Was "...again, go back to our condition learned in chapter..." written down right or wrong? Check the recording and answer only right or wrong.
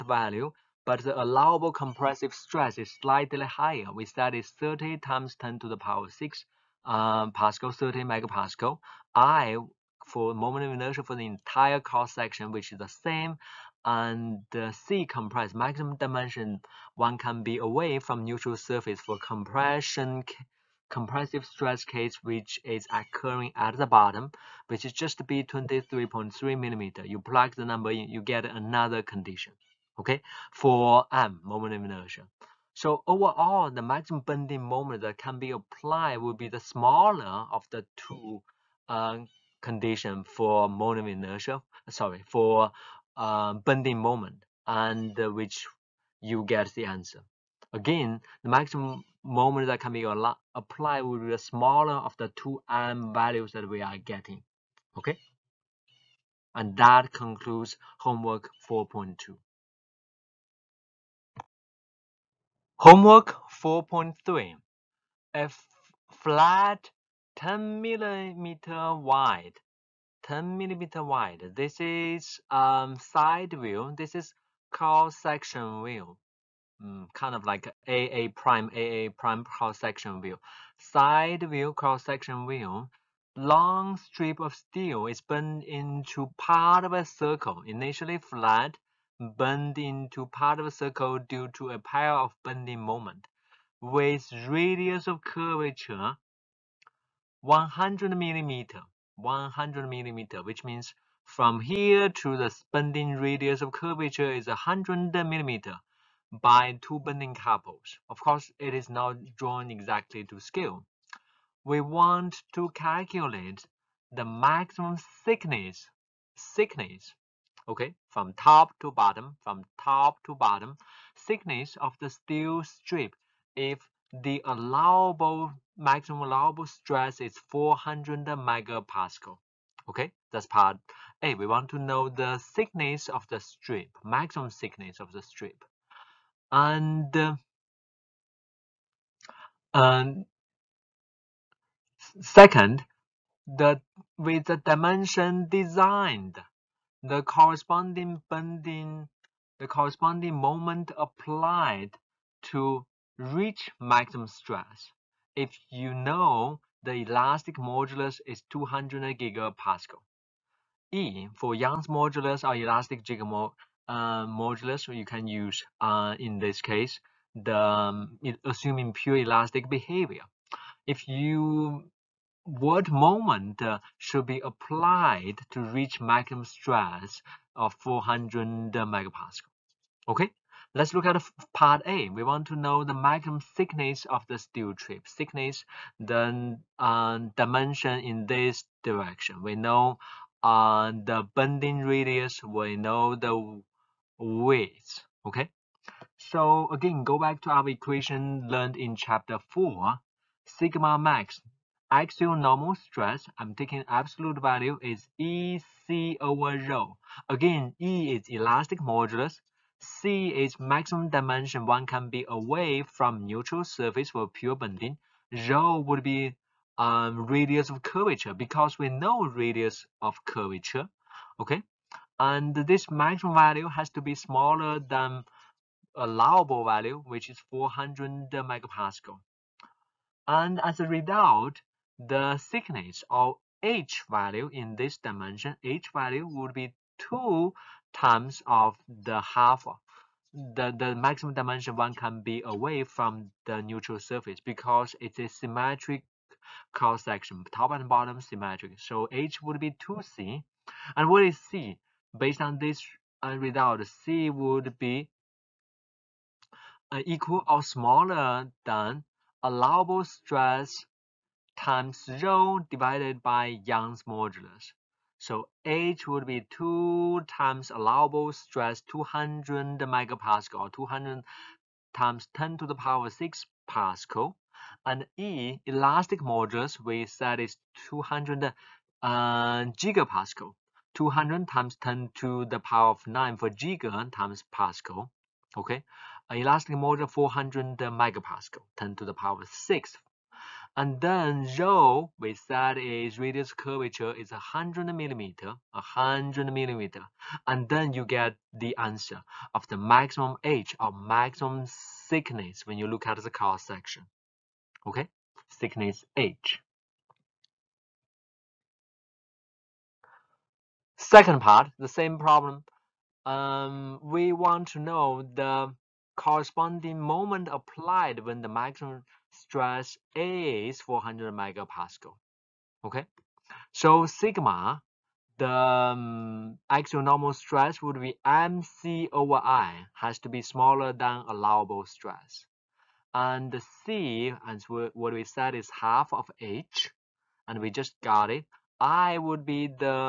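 wrong.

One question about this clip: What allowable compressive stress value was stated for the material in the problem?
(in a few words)
30 megapascal.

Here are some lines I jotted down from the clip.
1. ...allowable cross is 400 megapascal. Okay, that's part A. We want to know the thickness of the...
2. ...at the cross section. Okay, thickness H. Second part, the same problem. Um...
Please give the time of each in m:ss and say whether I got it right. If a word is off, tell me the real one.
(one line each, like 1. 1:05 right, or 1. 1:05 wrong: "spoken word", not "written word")
1. 2:06 wrong: "stress", not "cross"
2. 5:03 right.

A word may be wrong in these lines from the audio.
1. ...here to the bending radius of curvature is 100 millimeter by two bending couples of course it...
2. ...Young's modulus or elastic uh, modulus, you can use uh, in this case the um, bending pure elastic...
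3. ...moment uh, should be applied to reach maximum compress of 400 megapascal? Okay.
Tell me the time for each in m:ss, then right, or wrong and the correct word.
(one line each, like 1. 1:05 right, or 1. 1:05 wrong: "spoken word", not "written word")
1. 1:41 right
2. 2:41 wrong: "assuming", not "bending"
3. 2:52 wrong: "stress", not "compress".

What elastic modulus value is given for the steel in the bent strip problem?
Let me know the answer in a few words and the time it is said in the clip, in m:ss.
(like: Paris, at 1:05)
200 gigapascal, at 2:38.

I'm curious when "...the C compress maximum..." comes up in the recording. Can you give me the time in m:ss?
0:14.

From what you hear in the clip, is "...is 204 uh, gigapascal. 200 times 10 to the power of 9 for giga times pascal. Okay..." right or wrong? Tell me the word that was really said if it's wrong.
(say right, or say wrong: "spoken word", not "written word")
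wrong: "200", not "204".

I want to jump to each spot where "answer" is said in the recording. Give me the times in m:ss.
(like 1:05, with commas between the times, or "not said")
0:46, 4:58.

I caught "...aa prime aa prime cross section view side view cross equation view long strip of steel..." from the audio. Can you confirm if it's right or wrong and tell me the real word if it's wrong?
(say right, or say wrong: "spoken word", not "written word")
wrong: "section", not "equation".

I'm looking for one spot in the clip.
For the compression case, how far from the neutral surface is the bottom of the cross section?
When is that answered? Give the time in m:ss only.
0:25.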